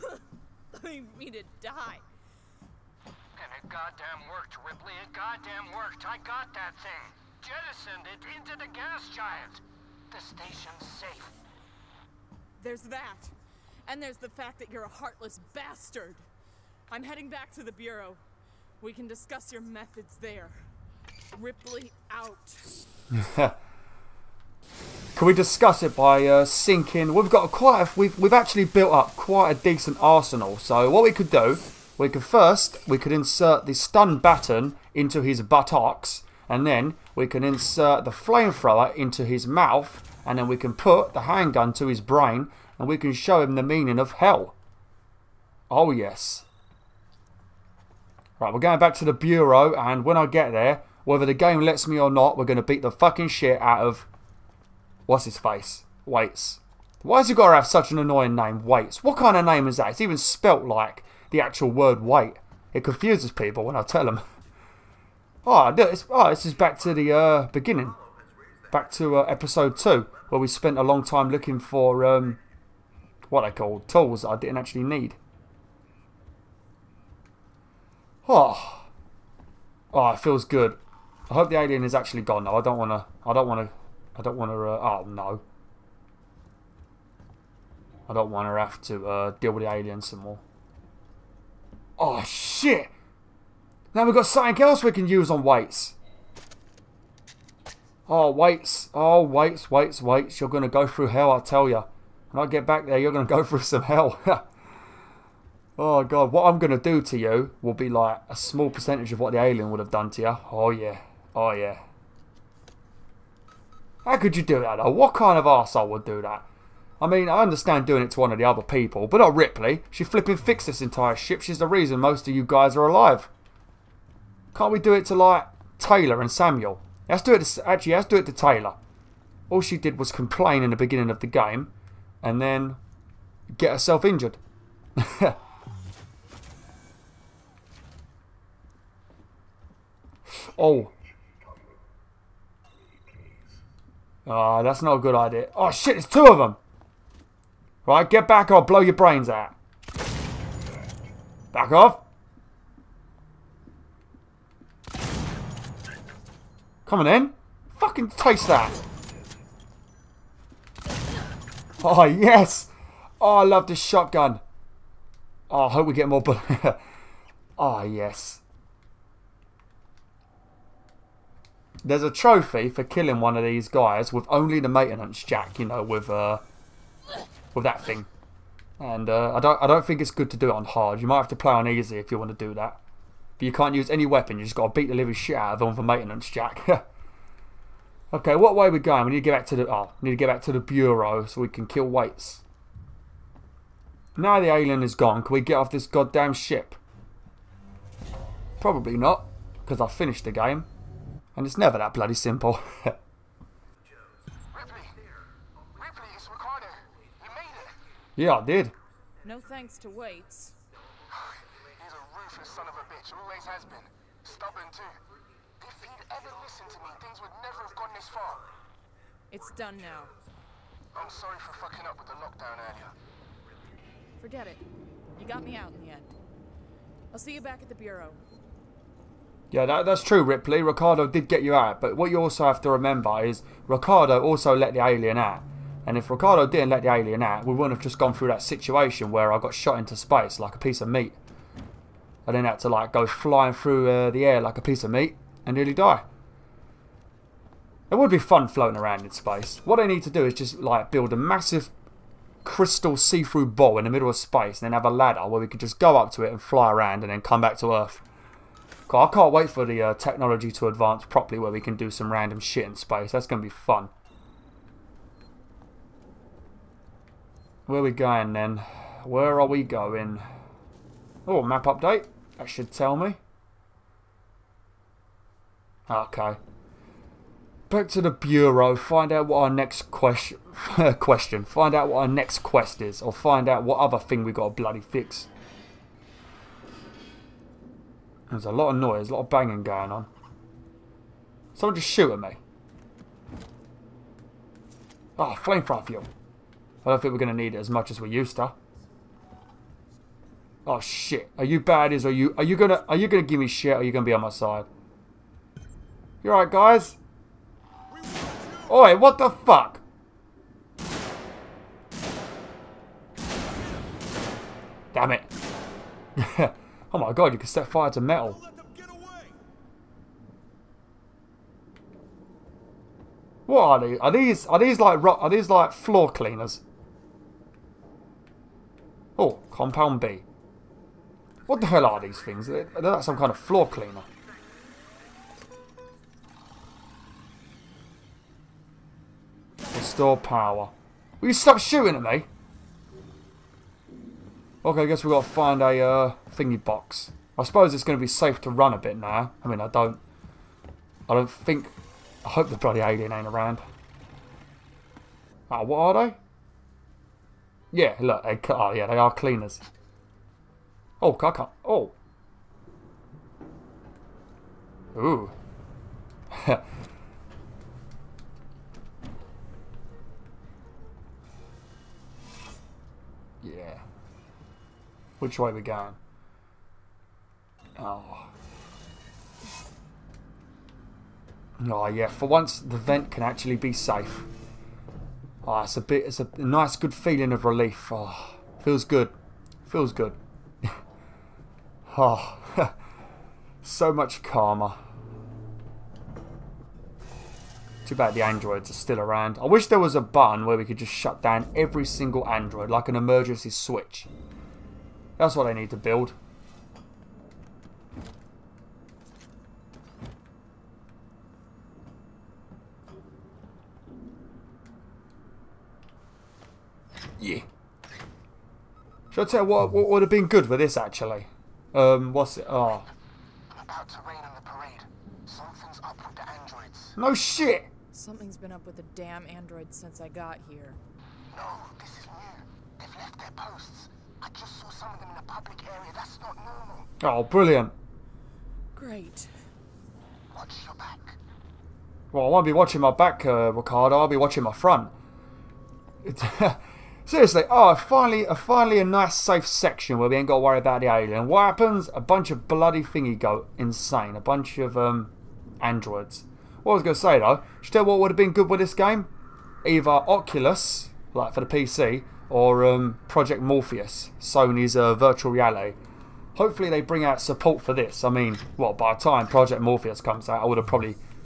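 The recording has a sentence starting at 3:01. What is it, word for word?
You might have to play on easy if you want to do that.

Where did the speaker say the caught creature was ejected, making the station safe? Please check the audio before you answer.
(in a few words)
The gas giant.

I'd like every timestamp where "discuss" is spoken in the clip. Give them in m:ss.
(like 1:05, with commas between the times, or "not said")
0:19, 0:25.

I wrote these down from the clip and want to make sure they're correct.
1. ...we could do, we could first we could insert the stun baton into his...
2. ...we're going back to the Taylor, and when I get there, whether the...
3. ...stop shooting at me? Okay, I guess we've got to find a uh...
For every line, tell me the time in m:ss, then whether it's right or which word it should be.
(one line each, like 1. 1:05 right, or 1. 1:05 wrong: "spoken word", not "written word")
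1. 0:31 right
2. 0:48 wrong: "Bureau", not "Taylor"
3. 5:41 right.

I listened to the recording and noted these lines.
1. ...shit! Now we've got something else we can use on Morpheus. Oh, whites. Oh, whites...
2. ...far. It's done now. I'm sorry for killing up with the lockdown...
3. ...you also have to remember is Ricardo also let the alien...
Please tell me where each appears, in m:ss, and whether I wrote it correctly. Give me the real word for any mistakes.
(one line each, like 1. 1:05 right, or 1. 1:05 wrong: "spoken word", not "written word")
1. 1:32 wrong: "Waits", not "Morpheus"
2. 3:38 wrong: "fucking", not "killing"
3. 3:52 right.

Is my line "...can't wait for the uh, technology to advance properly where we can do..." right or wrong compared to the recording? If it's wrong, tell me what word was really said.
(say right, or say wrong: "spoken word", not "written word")
right.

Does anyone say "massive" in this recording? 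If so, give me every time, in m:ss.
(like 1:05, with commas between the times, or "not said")
4:11.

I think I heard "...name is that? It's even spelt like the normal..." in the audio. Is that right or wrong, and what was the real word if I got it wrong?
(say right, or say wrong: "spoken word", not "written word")
wrong: "actual", not "normal".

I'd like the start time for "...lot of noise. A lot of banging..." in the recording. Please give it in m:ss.
4:48.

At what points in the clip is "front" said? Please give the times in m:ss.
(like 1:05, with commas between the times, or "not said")
7:24.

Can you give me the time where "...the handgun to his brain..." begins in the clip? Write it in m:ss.
0:41.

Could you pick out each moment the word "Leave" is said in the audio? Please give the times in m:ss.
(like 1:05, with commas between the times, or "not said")
0:00.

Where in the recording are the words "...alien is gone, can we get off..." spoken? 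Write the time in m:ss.
3:14.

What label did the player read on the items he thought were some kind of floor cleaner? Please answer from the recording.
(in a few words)
Compound B.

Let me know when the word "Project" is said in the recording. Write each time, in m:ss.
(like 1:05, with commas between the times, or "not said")
7:43, 7:49.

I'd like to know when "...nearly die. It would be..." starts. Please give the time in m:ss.
4:05.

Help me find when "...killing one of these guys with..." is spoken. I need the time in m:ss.
2:52.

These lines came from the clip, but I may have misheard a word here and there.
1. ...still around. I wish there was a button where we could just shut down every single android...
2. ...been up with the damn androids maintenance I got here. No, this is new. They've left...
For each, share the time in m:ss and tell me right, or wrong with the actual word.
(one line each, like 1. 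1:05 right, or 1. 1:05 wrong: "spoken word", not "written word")
1. 6:38 right
2. 7:08 wrong: "since", not "maintenance".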